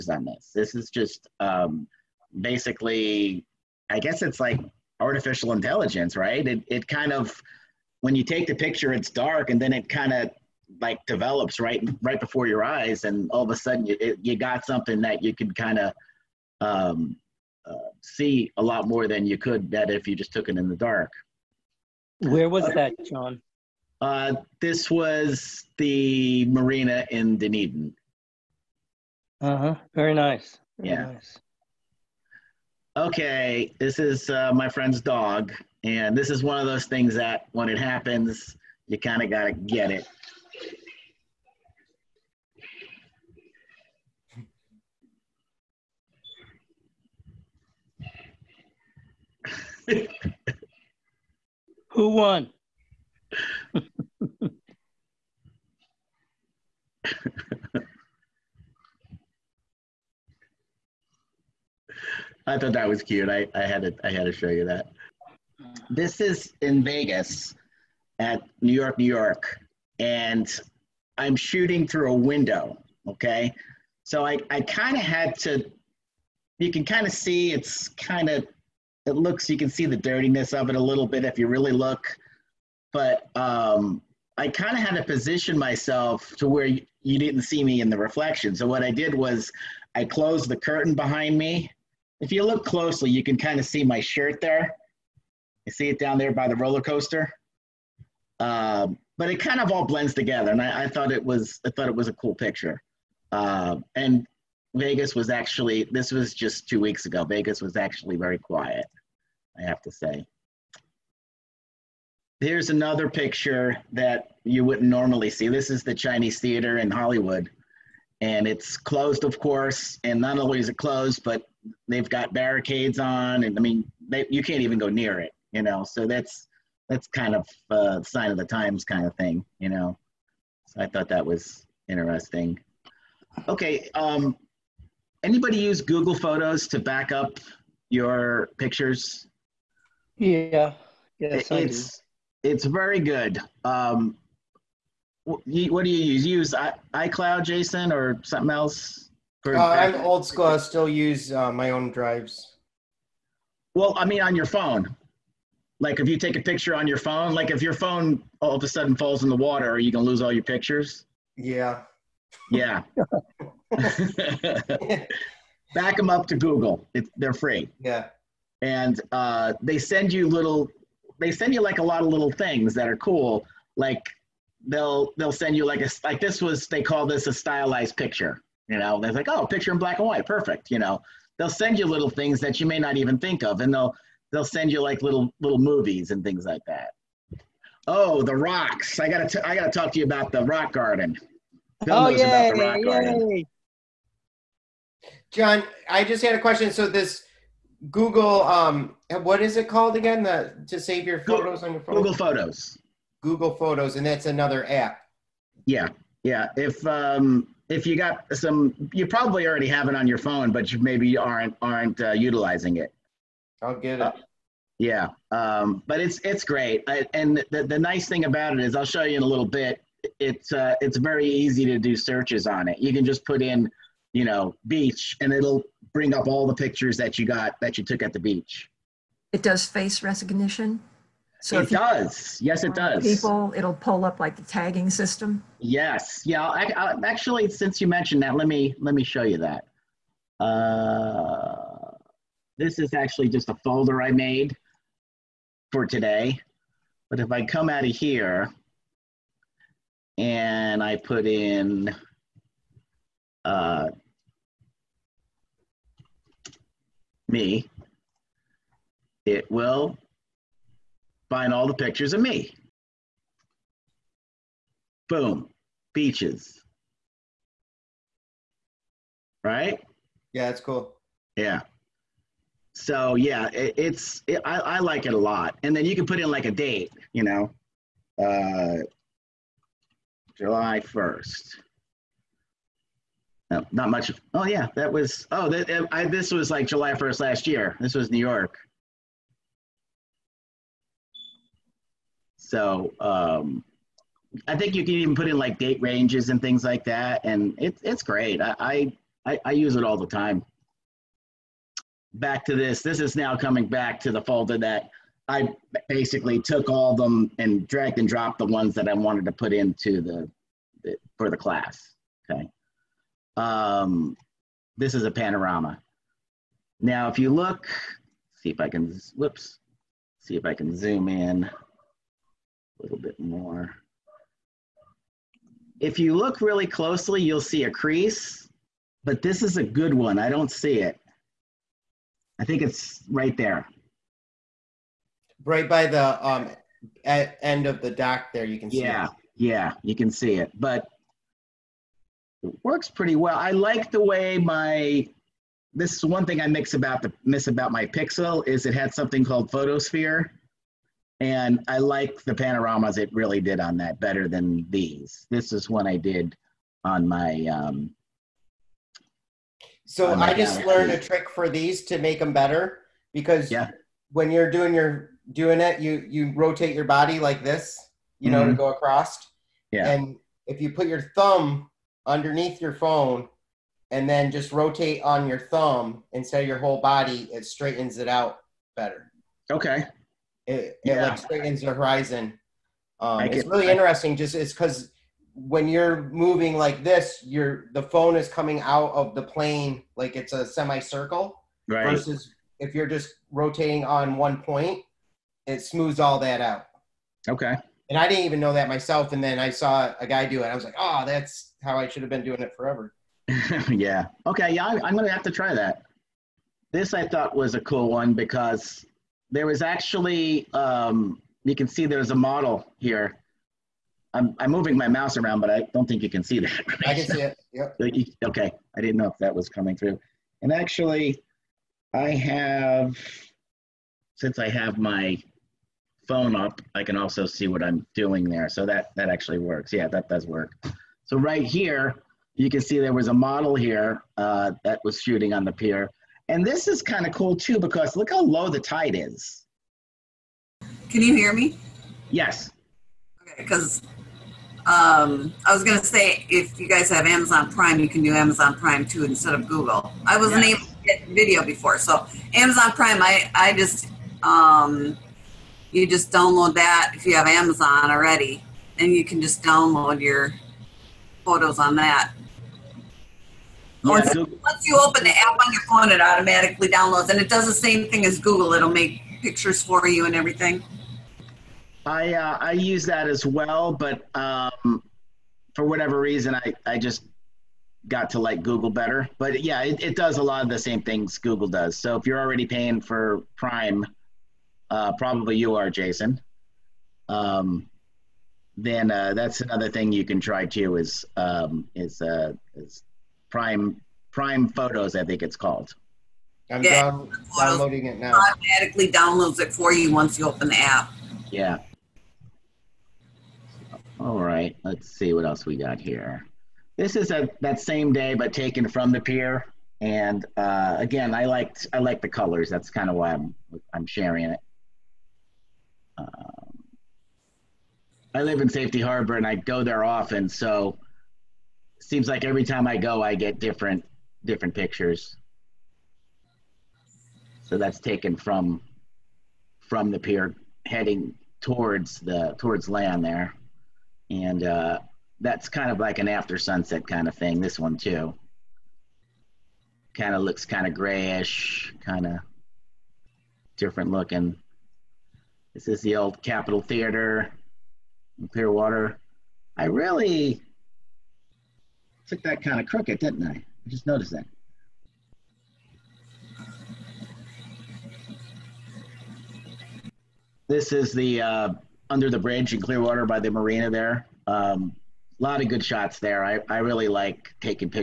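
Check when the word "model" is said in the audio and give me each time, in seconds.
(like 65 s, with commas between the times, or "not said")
412 s, 433 s.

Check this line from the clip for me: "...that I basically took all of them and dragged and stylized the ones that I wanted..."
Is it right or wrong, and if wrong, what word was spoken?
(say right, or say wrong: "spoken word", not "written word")
wrong: "dropped", not "stylized".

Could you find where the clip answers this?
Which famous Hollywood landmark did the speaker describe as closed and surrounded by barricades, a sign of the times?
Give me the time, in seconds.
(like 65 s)
115 s.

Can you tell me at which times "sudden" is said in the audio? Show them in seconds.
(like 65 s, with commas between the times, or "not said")
13 s, 158 s.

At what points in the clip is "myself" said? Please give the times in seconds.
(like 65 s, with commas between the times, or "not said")
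85 s, 398 s.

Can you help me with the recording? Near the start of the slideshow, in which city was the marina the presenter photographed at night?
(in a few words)
Dunedin.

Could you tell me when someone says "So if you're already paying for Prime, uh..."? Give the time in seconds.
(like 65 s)
481 s.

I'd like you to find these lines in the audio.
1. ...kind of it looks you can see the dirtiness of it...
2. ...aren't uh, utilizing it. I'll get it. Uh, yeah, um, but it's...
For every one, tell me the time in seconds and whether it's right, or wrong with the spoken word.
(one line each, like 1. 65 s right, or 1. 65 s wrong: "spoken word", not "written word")
1. 77 s right
2. 211 s right.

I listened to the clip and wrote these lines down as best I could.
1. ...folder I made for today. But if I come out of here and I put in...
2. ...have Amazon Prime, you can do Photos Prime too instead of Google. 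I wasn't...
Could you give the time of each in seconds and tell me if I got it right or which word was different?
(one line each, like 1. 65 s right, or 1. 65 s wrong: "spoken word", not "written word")
1. 243 s right
2. 446 s wrong: "Amazon", not "Photos".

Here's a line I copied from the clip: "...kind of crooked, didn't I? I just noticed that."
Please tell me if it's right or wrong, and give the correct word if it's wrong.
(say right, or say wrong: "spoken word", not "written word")
right.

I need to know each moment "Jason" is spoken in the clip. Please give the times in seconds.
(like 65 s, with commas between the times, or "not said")
147 s, 485 s.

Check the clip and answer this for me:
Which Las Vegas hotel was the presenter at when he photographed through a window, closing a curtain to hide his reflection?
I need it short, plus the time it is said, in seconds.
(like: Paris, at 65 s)
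New York, New York, at 68 s.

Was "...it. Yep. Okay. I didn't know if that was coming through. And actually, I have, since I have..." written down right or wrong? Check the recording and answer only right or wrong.
right.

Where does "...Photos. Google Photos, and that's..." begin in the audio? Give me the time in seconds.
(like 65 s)
202 s.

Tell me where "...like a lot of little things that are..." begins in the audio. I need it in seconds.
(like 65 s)
171 s.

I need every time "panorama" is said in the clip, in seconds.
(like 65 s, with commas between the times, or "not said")
315 s, 352 s.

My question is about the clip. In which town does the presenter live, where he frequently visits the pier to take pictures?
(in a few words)
Safety Harbor.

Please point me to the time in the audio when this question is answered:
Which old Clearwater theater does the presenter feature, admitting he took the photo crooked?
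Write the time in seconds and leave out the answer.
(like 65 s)
546 s.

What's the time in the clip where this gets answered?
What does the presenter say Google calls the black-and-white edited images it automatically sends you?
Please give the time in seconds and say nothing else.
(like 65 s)
177 s.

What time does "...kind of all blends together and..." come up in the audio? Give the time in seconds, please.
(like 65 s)
99 s.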